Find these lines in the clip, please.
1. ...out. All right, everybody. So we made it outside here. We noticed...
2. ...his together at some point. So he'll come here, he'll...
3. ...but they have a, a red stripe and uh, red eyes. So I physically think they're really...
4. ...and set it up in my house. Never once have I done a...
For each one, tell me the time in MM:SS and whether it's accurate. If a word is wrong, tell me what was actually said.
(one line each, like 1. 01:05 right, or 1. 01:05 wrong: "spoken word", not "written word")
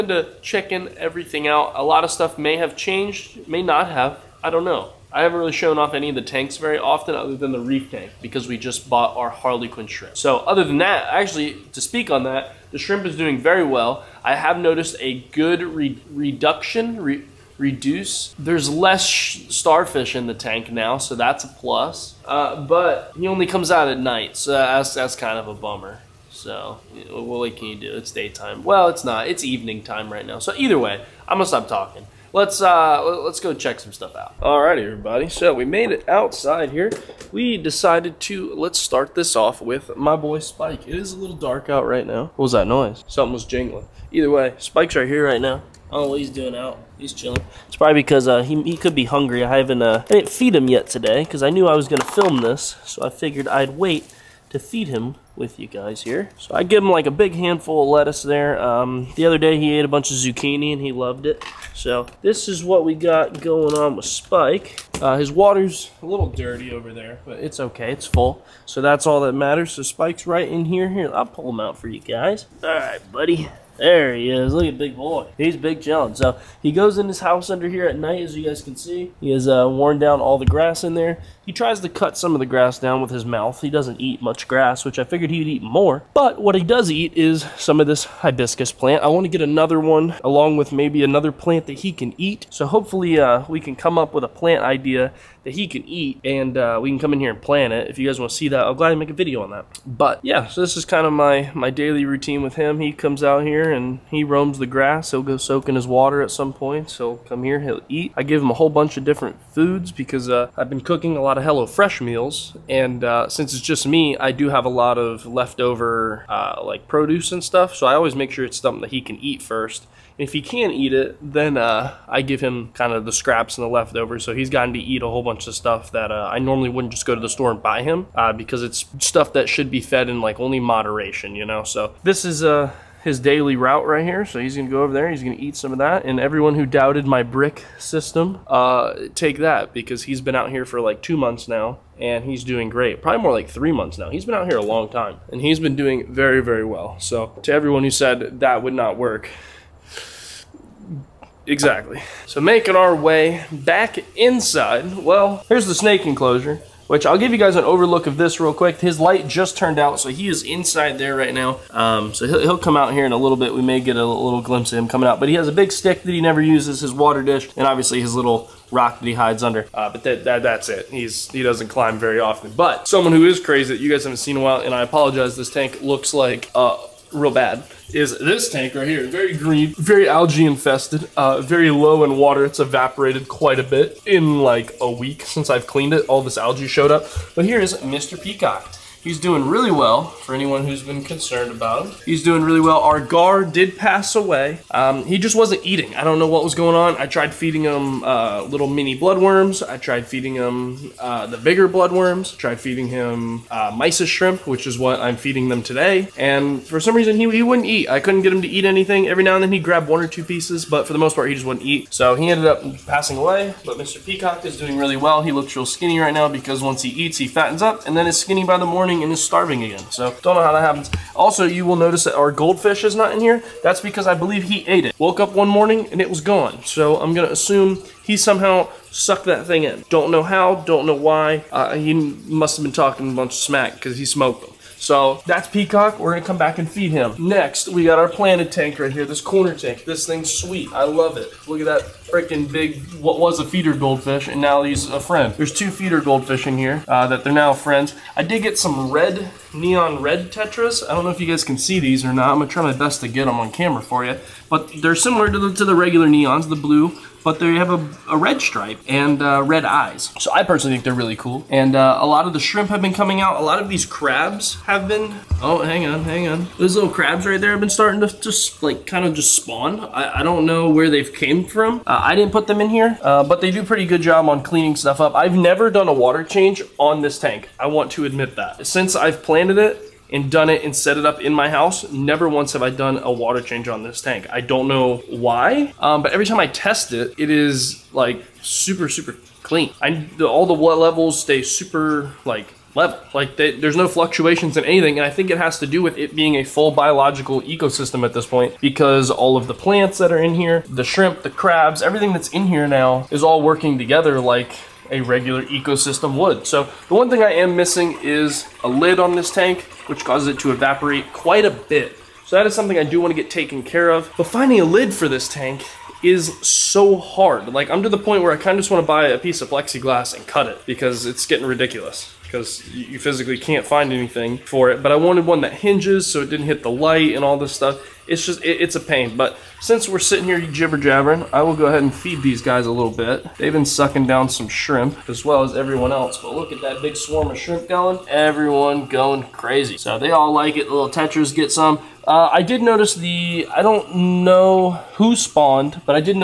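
1. 00:34 wrong: "decided", not "noticed"
2. 01:45 wrong: "water", not "together"
3. 04:17 wrong: "personally", not "physically"
4. 04:40 right.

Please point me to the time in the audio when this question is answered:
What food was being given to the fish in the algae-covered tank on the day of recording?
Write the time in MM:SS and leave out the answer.
03:23.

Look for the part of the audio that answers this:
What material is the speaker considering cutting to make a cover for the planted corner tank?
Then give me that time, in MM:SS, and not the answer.
05:19.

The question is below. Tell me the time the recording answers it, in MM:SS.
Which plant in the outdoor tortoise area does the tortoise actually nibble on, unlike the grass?
01:28.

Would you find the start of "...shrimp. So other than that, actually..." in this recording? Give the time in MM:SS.
00:09.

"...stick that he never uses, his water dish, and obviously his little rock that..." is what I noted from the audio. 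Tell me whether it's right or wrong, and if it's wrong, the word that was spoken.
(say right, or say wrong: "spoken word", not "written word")
right.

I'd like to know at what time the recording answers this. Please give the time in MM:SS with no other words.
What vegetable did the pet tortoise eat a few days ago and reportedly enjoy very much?
01:00.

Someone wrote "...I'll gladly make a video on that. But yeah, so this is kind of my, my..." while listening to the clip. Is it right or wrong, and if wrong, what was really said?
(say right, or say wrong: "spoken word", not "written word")
right.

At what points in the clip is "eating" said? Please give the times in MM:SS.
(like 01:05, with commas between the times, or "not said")
03:15.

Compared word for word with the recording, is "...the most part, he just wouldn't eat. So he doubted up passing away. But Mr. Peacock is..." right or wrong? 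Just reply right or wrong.
wrong.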